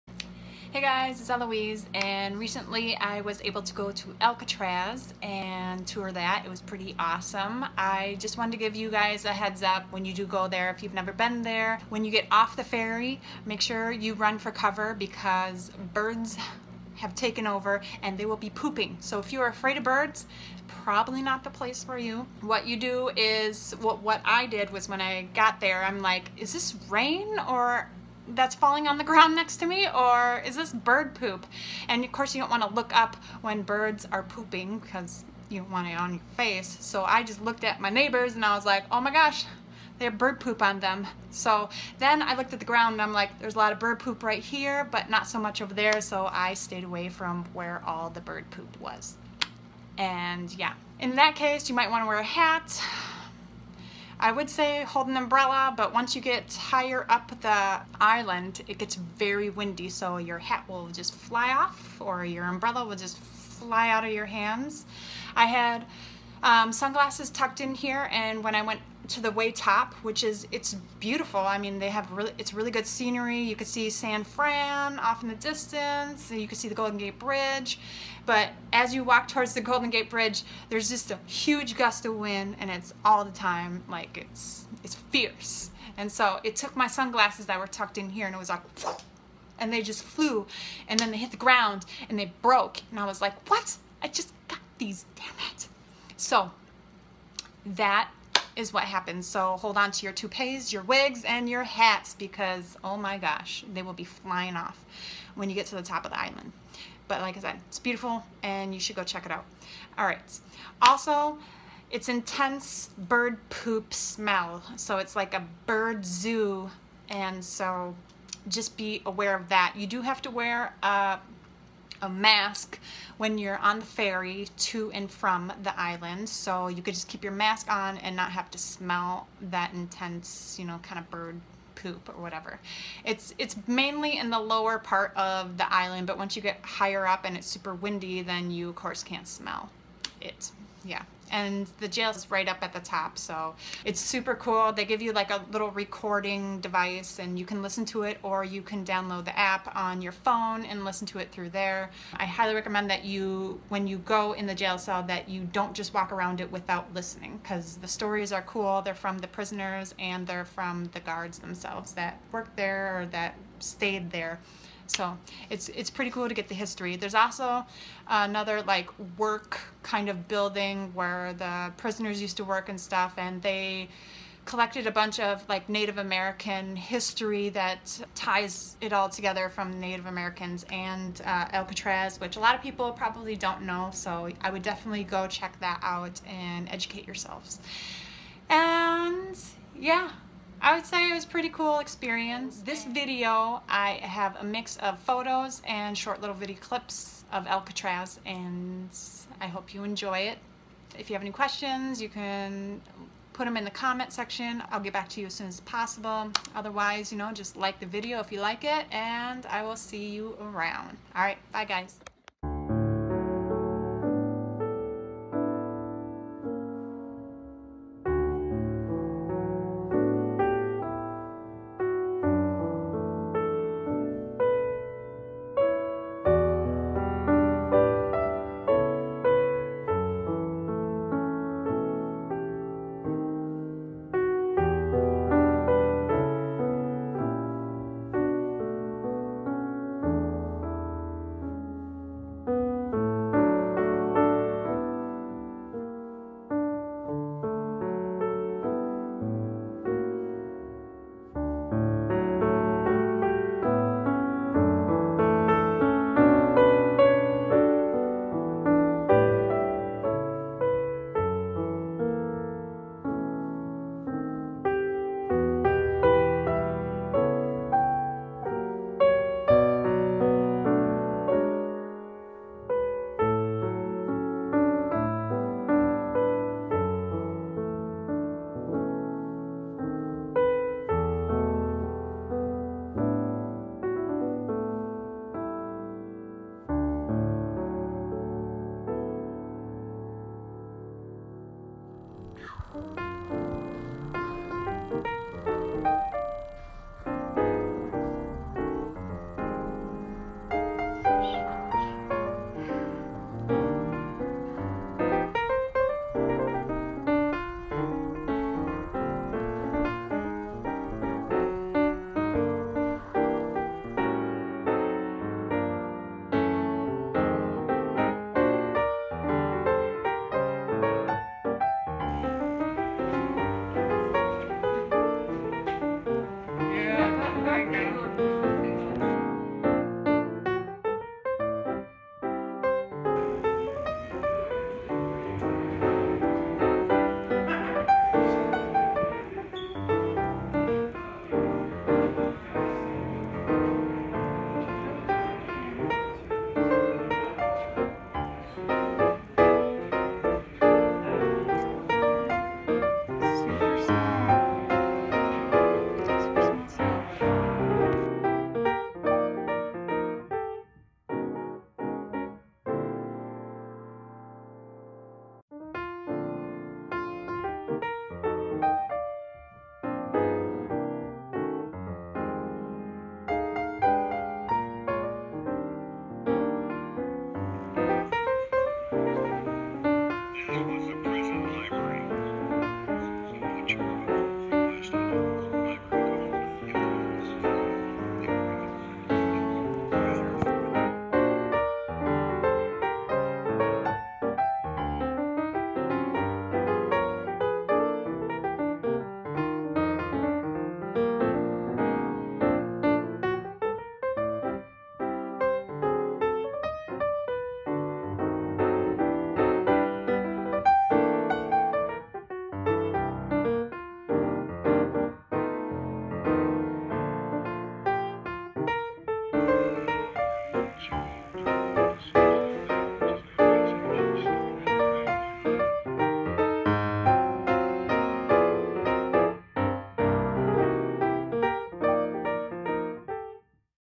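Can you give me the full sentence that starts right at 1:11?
I mean, they have really it's really good scenery.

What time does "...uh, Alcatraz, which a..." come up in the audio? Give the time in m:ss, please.
3:01.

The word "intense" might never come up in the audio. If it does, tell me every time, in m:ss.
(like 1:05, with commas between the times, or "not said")
1:52, 2:09.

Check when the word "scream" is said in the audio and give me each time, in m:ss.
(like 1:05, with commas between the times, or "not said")
not said.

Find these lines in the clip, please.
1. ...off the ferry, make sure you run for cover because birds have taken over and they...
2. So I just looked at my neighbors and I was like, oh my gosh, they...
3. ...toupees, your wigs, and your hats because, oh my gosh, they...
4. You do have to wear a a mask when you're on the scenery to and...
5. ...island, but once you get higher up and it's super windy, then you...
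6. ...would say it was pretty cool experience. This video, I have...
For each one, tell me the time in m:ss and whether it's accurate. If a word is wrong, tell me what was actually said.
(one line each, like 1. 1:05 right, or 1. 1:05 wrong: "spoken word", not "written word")
1. 0:12 right
2. 0:36 right
3. 1:40 right
4. 1:59 wrong: "ferry", not "scenery"
5. 2:15 right
6. 3:10 right.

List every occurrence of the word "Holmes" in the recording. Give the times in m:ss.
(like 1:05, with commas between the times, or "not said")
not said.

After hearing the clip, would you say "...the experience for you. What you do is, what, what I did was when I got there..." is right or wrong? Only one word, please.
wrong.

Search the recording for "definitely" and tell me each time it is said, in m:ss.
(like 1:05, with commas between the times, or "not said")
3:04.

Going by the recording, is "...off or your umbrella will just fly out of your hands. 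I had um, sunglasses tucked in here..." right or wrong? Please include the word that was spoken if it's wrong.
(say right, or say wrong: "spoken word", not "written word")
right.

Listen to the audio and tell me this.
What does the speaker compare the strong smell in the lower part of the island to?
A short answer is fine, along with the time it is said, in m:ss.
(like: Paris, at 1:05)
A bird zoo, at 1:55.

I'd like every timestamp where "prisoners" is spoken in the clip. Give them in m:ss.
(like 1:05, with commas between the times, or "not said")
2:39, 2:51.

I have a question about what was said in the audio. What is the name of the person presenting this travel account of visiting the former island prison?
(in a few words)
Eloise.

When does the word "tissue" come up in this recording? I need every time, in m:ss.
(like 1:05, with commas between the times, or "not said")
not said.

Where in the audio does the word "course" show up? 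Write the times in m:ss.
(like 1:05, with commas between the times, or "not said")
0:32, 2:18.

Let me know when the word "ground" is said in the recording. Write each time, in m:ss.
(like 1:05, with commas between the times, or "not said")
0:29, 0:42, 1:31.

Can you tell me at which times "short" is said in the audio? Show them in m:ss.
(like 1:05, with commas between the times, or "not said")
3:15.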